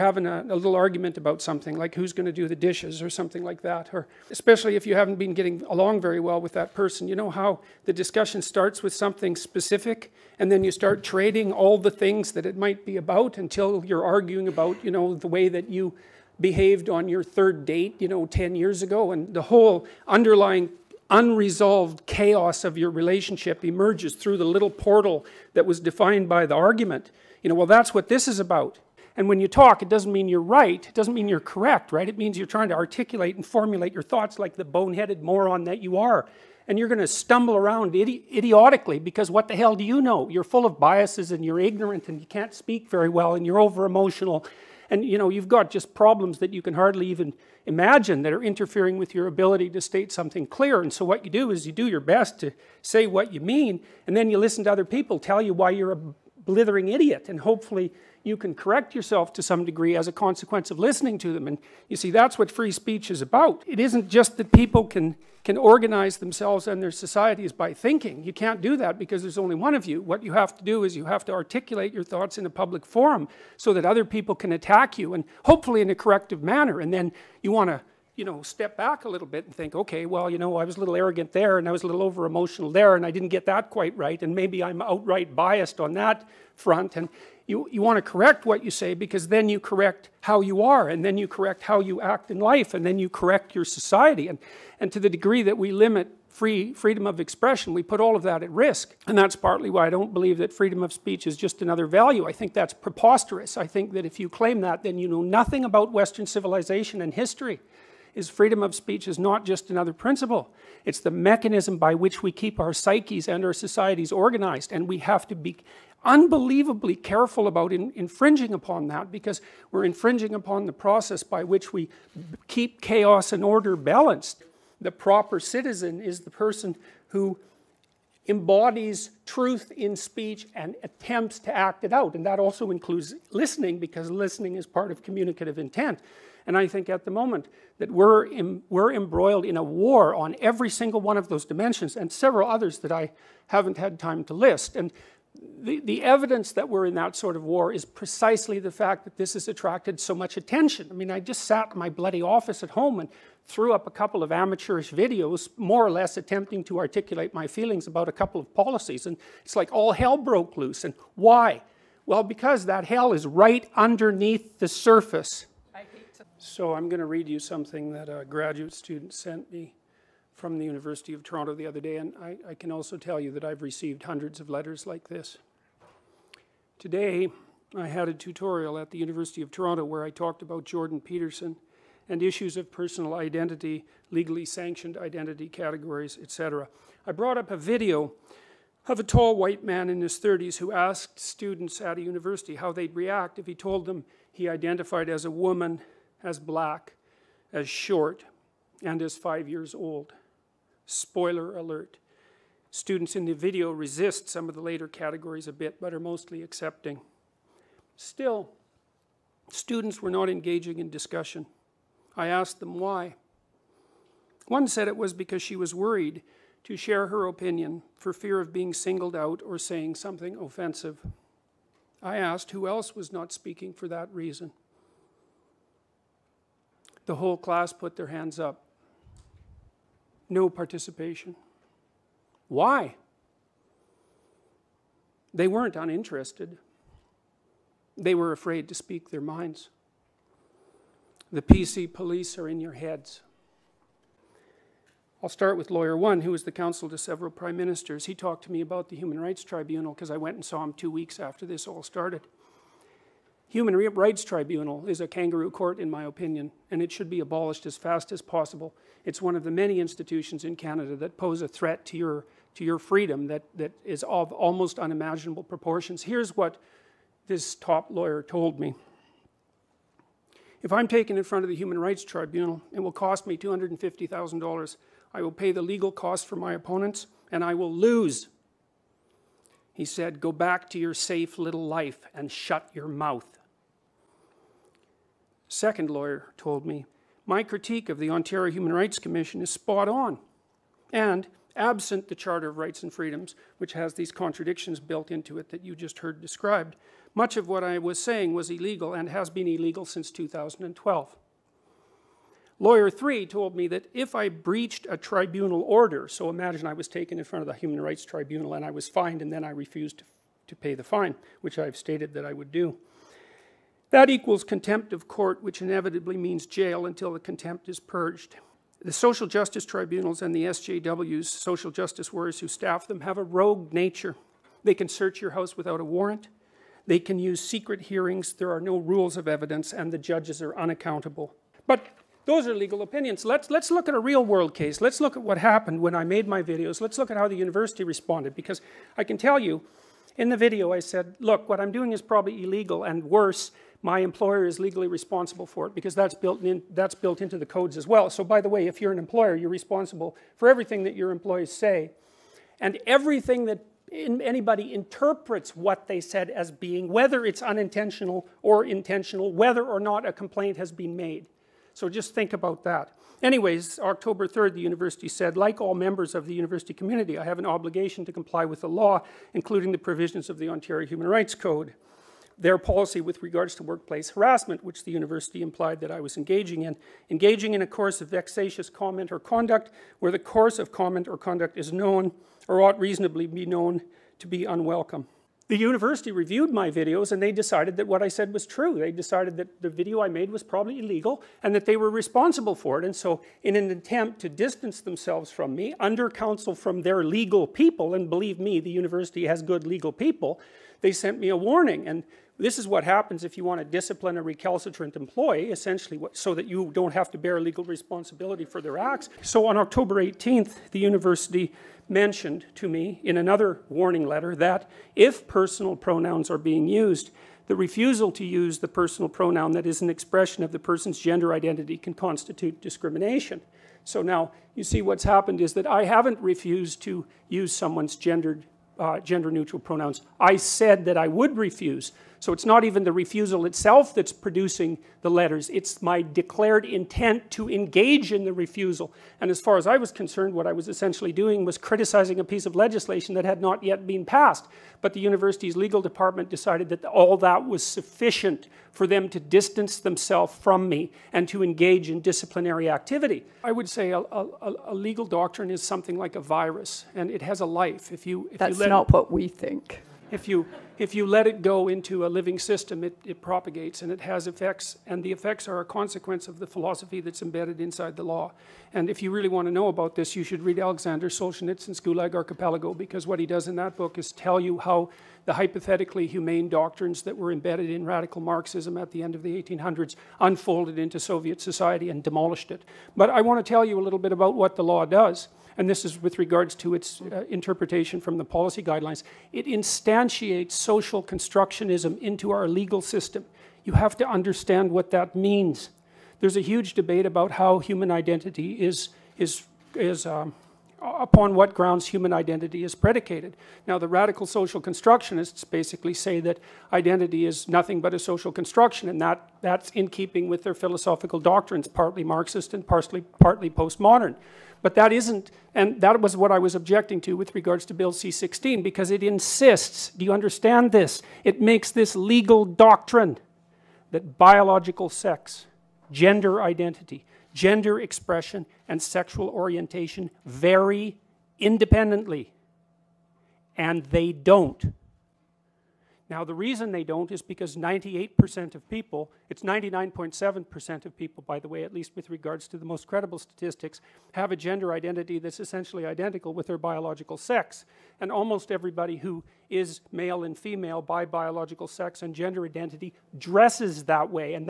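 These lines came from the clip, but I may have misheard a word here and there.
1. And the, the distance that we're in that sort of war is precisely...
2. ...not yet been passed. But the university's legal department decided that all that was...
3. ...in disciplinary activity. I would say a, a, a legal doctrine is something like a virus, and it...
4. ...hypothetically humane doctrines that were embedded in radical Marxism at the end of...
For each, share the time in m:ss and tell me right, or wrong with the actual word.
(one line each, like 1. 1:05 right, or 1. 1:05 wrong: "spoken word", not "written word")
1. 2:24 wrong: "evidence", not "distance"
2. 7:23 right
3. 7:31 right
4. 7:55 right.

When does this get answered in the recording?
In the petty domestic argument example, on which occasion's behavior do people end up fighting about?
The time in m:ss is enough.
0:17.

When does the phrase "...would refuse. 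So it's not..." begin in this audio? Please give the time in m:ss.
7:11.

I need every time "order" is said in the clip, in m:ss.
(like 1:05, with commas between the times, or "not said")
2:03, 5:05.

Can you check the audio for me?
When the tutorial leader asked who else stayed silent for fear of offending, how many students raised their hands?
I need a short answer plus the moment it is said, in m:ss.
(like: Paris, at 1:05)
The whole class, at 3:47.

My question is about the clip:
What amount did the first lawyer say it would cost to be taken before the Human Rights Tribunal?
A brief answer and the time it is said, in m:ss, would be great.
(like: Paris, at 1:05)
$250,000, at 4:33.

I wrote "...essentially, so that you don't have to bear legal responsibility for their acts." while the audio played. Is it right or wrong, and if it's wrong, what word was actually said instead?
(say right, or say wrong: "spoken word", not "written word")
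right.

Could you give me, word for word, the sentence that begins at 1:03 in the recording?
It isn't just that people can, can organize themselves and their societies by thinking.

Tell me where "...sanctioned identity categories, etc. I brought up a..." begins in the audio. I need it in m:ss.
3:04.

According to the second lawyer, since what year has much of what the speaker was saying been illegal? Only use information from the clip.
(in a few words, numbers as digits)
2012.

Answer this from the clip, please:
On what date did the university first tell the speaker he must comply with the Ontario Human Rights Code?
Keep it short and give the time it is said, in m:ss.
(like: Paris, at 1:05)
October 3rd, at 6:03.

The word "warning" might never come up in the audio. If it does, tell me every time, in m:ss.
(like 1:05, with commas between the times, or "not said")
6:41, 6:53.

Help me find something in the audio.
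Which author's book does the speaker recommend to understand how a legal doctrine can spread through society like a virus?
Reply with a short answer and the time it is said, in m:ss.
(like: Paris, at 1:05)
Alexander Solzhenitsyn, at 7:50.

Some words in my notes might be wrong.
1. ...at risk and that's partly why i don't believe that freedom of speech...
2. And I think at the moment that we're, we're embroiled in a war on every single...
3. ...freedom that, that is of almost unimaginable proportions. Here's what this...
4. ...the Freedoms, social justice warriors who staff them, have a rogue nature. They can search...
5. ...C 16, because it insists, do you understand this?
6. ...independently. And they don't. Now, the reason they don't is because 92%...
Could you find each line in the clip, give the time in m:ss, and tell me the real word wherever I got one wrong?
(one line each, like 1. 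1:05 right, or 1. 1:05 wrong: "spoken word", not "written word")
1. 1:38 right
2. 2:16 right
3. 4:22 right
4. 5:20 wrong: "SJWs", not "Freedoms"
5. 8:37 right
6. 8:51 wrong: "98", not "92".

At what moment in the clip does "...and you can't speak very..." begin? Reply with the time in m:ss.
0:42.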